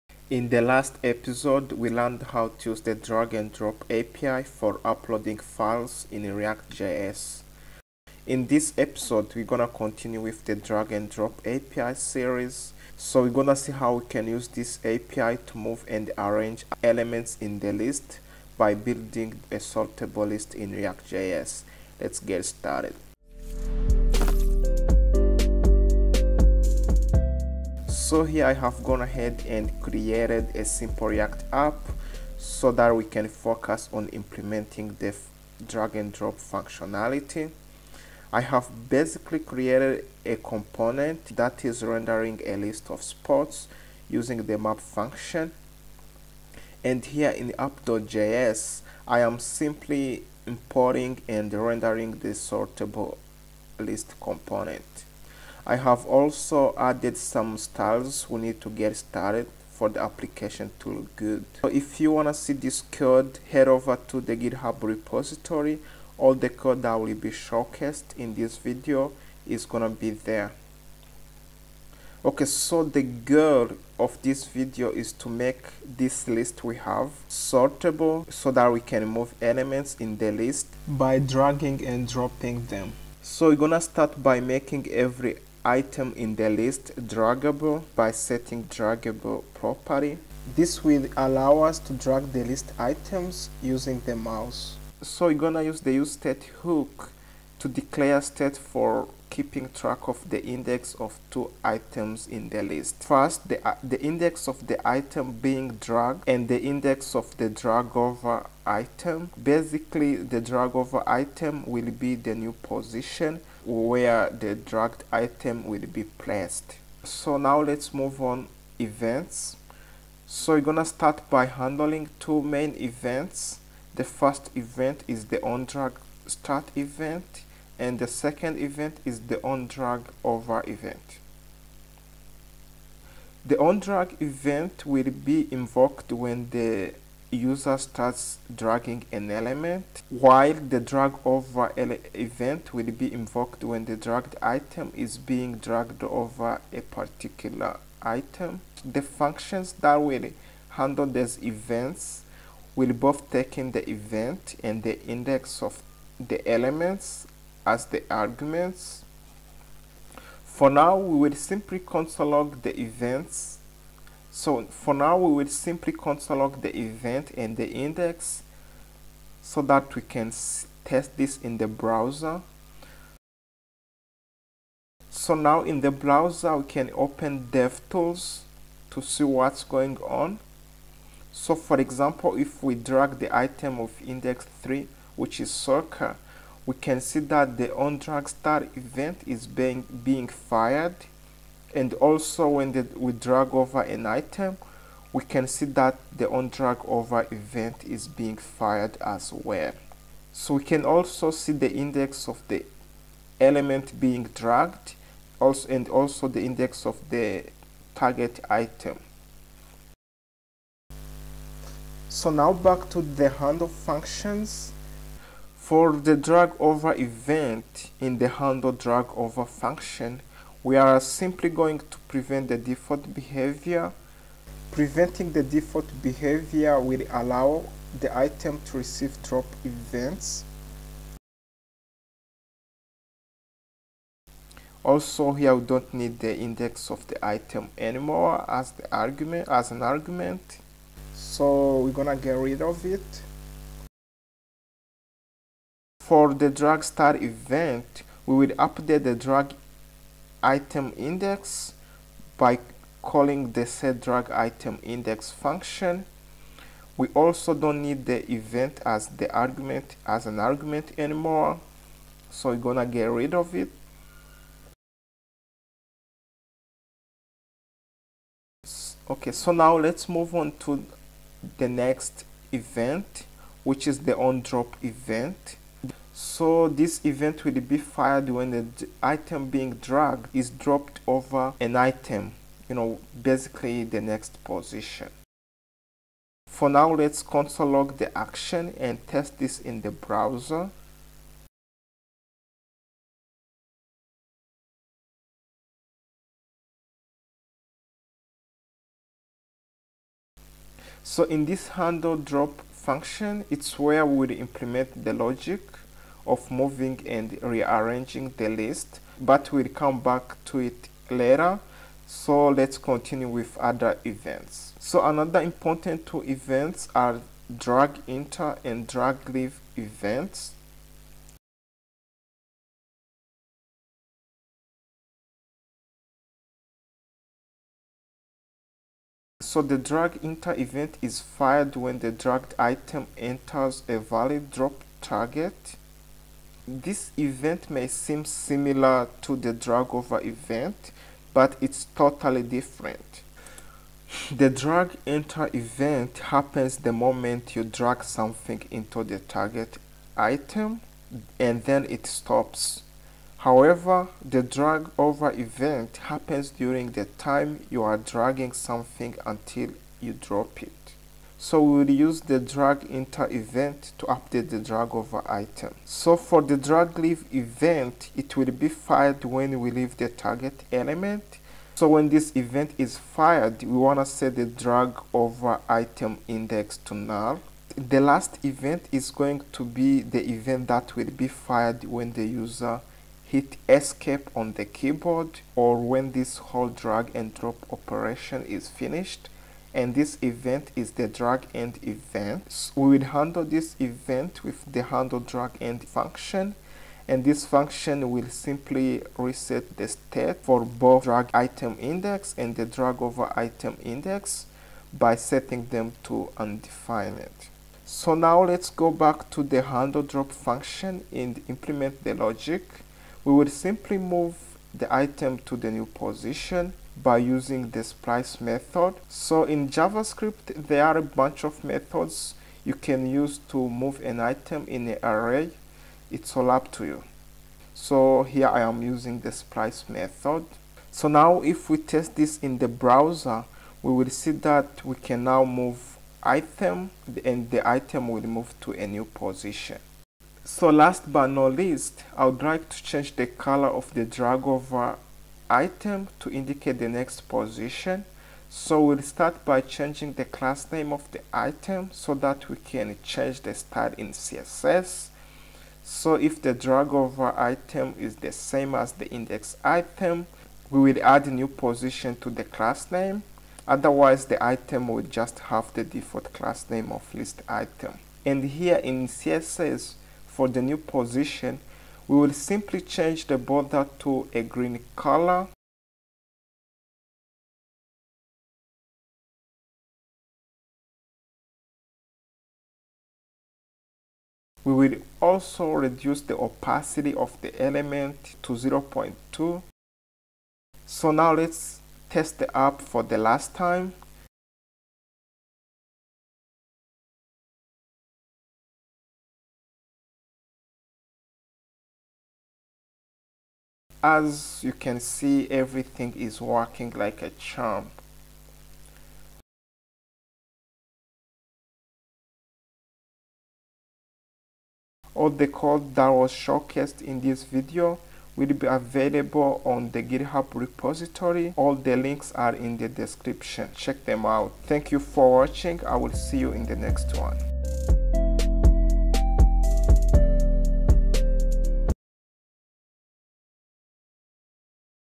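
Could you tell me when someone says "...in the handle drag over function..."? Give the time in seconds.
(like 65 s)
217 s.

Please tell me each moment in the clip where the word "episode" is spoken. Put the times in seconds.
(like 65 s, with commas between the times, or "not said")
1 s, 8 s.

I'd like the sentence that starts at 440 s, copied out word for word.
So last but not least, I would like to change the color of the drag over item to indicate the next position.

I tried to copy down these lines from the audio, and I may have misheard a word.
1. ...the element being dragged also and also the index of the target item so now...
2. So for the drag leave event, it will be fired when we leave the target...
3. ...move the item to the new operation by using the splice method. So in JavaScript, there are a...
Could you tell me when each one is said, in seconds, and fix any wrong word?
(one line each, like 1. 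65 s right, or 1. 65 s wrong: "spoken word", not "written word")
1. 202 s right
2. 365 s right
3. 413 s wrong: "position", not "operation".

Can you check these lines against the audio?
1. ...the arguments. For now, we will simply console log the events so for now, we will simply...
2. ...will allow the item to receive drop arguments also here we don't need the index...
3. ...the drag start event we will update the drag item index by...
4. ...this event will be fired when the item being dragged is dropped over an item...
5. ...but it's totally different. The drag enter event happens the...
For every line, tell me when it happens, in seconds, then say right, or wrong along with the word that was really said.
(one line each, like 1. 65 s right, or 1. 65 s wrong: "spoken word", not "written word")
1. 157 s right
2. 226 s wrong: "events", not "arguments"
3. 246 s right
4. 276 s right
5. 341 s right.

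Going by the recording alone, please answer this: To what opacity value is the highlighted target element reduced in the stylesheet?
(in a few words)
0.2.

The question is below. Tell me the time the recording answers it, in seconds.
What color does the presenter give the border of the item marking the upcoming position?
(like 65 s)
474 s.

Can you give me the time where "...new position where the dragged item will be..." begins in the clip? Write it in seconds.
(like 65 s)
112 s.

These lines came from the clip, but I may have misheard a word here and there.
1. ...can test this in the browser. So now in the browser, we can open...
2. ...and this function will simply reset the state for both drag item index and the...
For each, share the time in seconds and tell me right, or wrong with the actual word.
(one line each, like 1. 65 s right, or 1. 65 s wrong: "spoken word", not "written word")
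1. 170 s right
2. 397 s right.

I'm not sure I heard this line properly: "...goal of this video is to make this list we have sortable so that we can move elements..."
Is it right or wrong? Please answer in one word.
right.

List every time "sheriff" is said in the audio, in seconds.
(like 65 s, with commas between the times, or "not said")
not said.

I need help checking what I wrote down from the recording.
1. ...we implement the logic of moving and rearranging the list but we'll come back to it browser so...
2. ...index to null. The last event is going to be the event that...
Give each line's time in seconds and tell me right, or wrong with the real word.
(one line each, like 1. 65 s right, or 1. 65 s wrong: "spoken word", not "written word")
1. 304 s wrong: "later", not "browser"
2. 376 s right.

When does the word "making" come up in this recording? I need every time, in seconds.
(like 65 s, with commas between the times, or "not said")
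84 s.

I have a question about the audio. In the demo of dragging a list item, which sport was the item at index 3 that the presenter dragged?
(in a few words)
soccer.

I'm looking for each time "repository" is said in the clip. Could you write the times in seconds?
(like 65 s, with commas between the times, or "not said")
64 s, 520 s.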